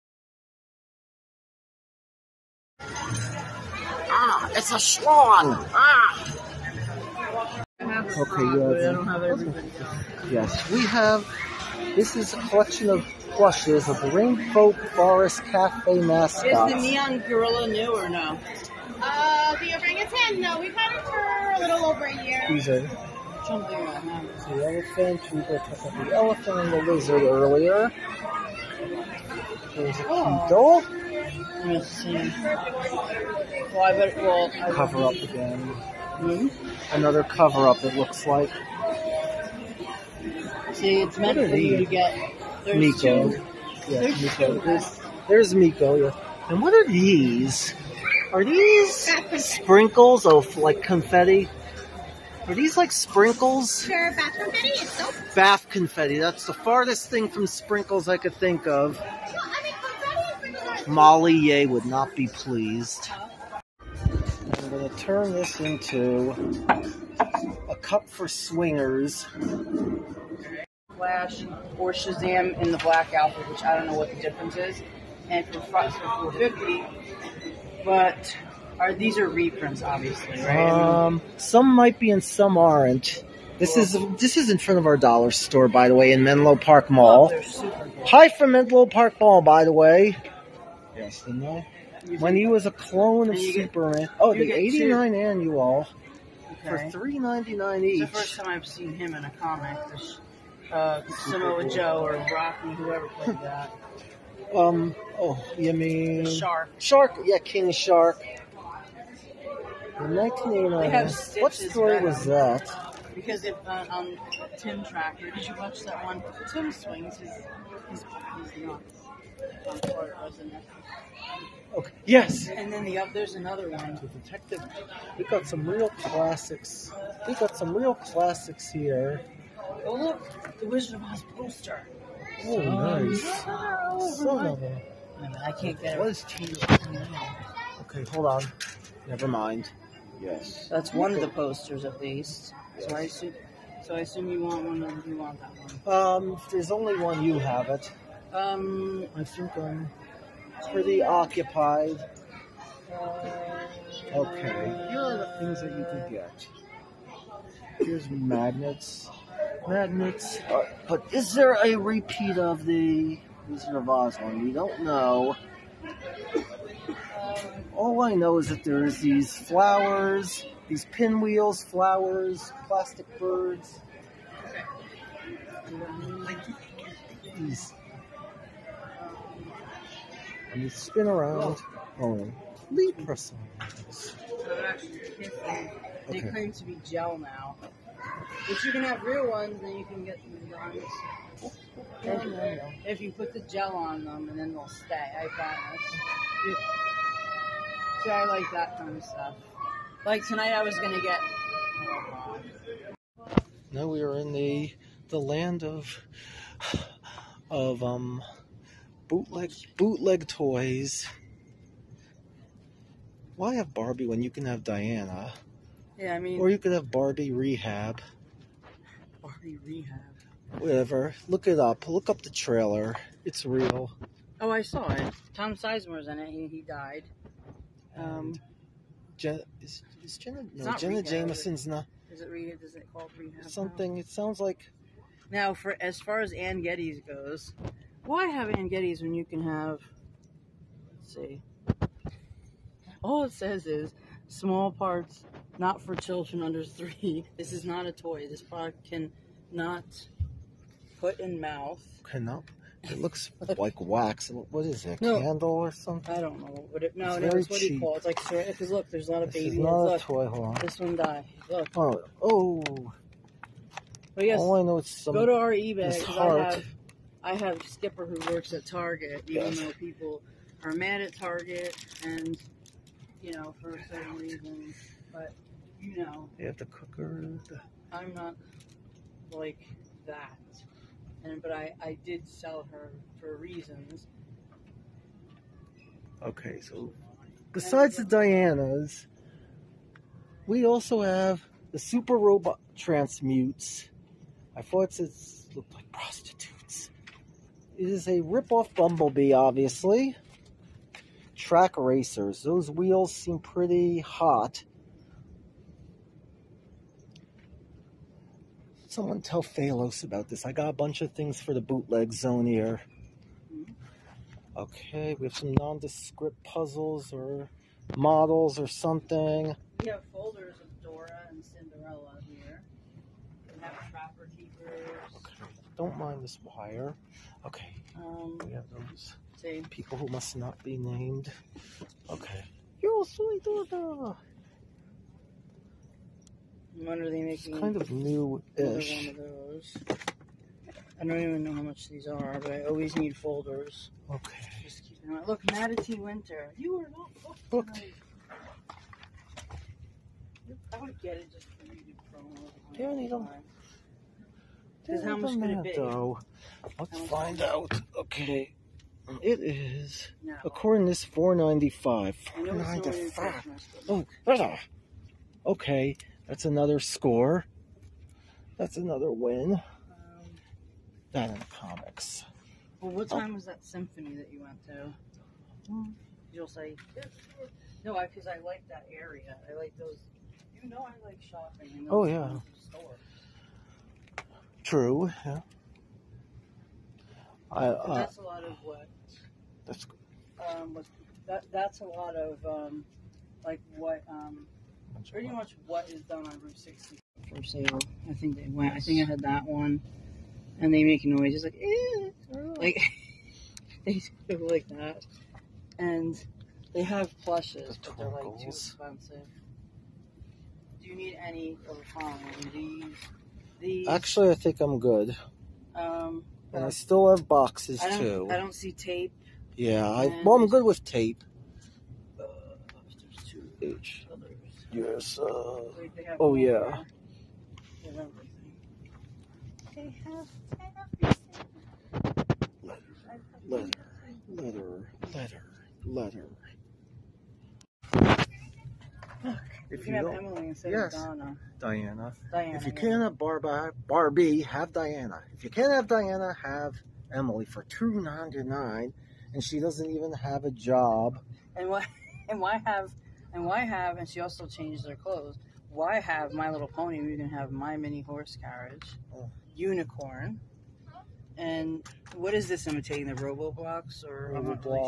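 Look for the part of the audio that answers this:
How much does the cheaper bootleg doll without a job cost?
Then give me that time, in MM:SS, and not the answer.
07:27.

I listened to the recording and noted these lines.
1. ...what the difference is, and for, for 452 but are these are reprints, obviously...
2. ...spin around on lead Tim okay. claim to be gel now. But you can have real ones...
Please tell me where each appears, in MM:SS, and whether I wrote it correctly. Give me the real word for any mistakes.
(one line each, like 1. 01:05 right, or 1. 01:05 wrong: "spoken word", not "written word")
1. 01:13 wrong: "450", not "452"
2. 03:00 wrong: "They", not "Tim".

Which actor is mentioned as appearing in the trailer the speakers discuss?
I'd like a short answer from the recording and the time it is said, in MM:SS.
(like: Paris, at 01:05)
Tom Sizemore, at 03:45.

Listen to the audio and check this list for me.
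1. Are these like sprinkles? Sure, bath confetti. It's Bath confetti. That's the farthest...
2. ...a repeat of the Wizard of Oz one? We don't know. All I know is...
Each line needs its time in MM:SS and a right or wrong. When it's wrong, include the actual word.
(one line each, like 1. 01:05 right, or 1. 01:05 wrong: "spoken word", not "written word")
1. 00:52 right
2. 02:41 right.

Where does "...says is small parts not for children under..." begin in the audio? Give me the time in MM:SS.
04:03.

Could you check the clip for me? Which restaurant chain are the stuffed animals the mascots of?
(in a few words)
Rainbow Forest Cafe.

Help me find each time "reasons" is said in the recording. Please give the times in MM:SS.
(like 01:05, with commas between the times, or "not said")
04:34, 04:43.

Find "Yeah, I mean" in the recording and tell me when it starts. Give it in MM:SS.
03:35.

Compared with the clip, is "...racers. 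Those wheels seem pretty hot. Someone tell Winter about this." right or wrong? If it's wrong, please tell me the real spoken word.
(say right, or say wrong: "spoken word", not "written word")
wrong: "Phalos", not "Winter".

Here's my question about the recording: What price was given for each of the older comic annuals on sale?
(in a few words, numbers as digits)
$3.99.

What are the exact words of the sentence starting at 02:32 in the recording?
Uh, okay, here are the things that you could get.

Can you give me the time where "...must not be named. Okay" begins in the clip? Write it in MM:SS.
05:30.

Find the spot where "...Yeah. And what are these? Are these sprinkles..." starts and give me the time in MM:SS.
00:45.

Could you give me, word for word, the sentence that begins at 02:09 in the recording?
Oh look, the Wizard of Oz poster.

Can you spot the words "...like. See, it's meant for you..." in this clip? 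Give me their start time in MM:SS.
00:38.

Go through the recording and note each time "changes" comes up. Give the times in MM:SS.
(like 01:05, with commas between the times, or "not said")
07:34.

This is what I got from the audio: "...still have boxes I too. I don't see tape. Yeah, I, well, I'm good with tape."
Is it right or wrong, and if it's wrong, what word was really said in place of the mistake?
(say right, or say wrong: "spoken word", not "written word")
right.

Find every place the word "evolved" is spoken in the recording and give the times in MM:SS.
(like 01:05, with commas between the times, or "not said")
not said.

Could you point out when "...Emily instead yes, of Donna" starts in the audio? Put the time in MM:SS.
07:20.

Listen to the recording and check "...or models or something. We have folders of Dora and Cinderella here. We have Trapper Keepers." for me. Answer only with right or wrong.
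right.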